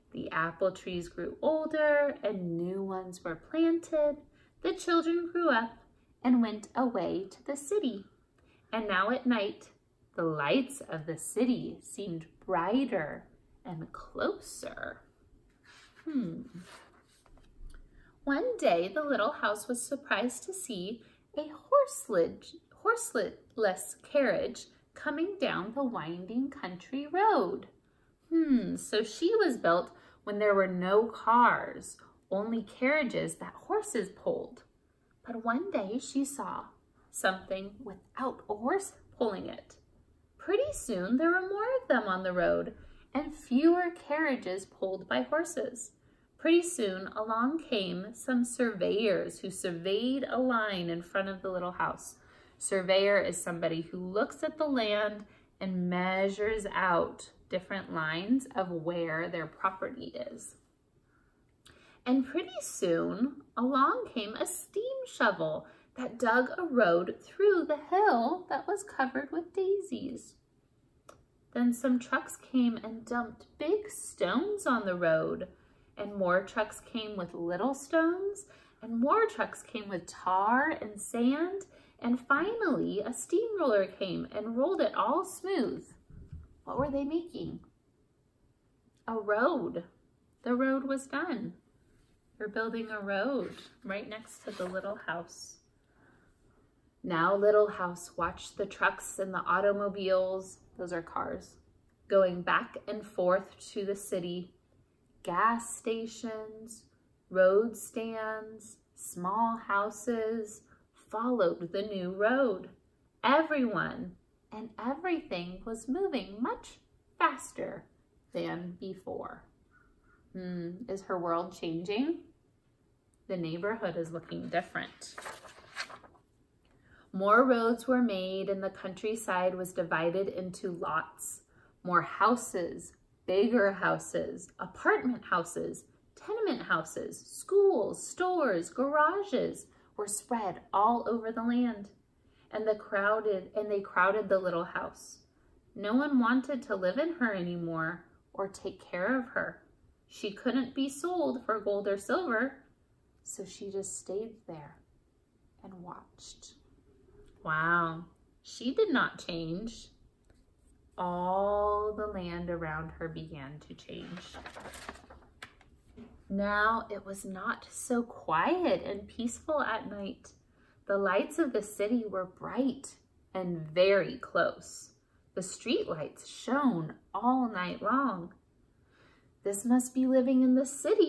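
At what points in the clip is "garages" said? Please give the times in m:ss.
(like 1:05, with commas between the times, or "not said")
2:18.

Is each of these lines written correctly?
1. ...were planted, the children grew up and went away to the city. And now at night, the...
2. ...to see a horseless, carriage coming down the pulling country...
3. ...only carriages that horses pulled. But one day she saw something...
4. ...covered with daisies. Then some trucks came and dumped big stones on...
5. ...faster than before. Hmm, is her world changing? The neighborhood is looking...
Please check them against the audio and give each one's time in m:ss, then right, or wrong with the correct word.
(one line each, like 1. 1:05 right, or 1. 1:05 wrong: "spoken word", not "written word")
1. 0:03 right
2. 0:20 wrong: "winding", not "pulling"
3. 0:32 right
4. 1:08 right
5. 1:57 right.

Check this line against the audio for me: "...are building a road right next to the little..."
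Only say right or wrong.
right.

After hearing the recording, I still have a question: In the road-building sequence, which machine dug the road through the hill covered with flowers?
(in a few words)
steam shovel.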